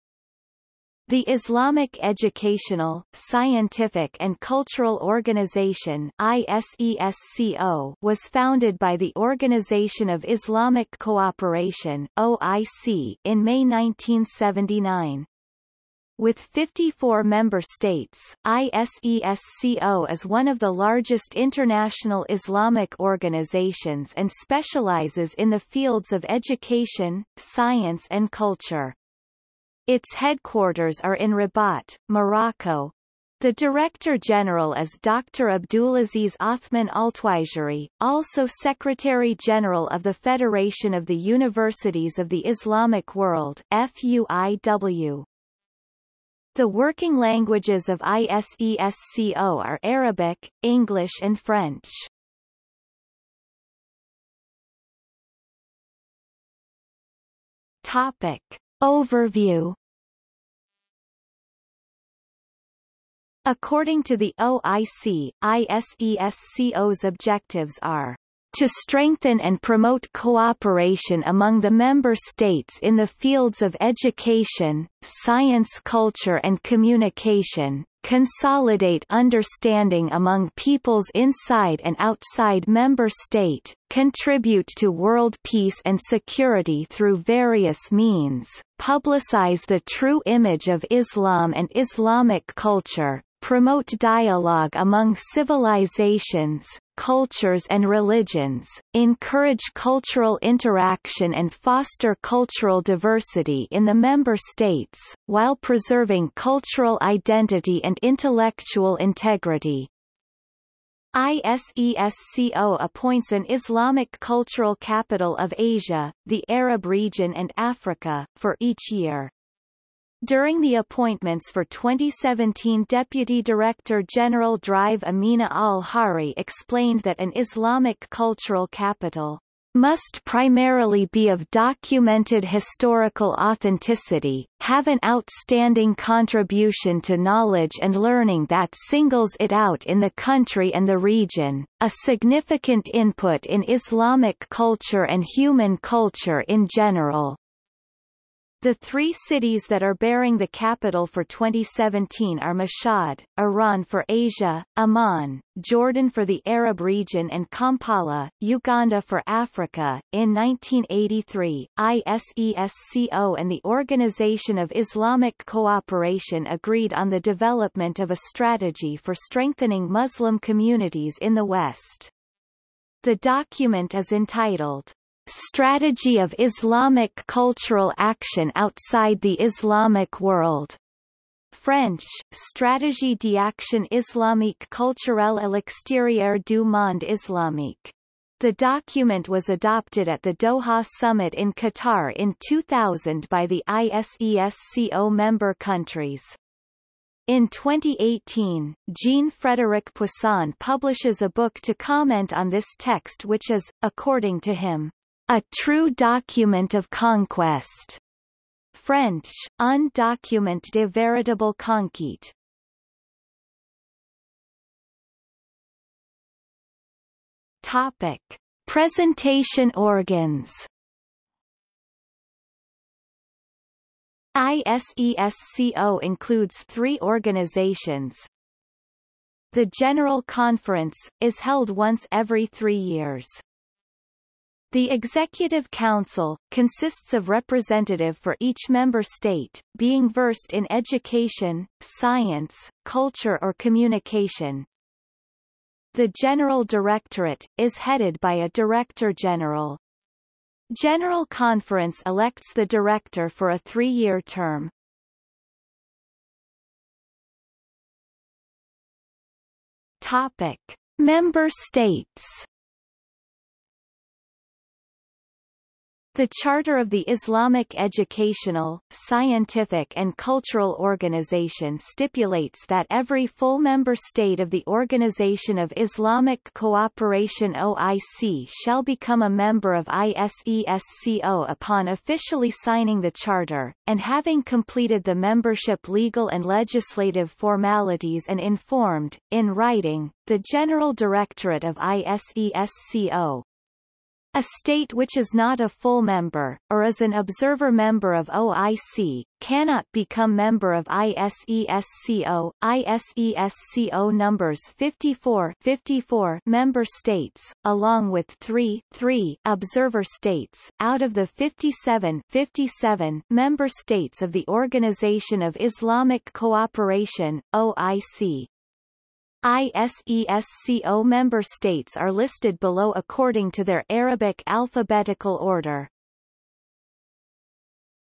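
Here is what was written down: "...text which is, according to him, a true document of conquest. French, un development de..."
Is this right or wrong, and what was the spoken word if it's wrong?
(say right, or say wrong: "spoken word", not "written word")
wrong: "document", not "development".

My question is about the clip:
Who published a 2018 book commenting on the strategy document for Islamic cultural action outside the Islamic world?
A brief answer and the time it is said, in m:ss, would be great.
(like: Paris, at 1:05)
Jean-Frédéric Poisson, at 3:18.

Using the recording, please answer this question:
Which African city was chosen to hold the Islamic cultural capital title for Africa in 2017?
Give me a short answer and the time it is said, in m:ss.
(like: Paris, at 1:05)
Kampala, at 2:37.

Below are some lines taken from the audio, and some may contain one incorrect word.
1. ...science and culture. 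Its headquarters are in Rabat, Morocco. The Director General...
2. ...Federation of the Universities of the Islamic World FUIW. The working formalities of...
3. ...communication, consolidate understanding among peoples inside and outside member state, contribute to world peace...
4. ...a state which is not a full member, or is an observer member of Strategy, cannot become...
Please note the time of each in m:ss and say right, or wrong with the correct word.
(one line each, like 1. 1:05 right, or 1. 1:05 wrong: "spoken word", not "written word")
1. 0:27 right
2. 0:40 wrong: "languages", not "formalities"
3. 1:16 right
4. 4:54 wrong: "OIC", not "Strategy".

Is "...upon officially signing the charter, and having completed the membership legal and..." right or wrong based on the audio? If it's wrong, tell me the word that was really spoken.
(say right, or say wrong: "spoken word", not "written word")
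right.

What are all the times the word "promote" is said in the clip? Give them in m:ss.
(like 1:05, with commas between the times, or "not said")
1:09, 1:33.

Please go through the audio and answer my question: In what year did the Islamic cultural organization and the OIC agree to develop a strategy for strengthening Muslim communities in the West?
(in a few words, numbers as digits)
1983.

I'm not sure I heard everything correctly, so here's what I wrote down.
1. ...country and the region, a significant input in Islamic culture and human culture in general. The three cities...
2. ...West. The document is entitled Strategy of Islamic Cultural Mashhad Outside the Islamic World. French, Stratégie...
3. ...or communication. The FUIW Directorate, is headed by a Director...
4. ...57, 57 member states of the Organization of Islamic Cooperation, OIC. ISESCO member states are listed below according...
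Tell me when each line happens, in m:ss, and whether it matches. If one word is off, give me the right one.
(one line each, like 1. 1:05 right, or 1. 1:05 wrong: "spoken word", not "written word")
1. 2:20 right
2. 2:51 wrong: "Action", not "Mashhad"
3. 4:03 wrong: "General", not "FUIW"
4. 5:11 right.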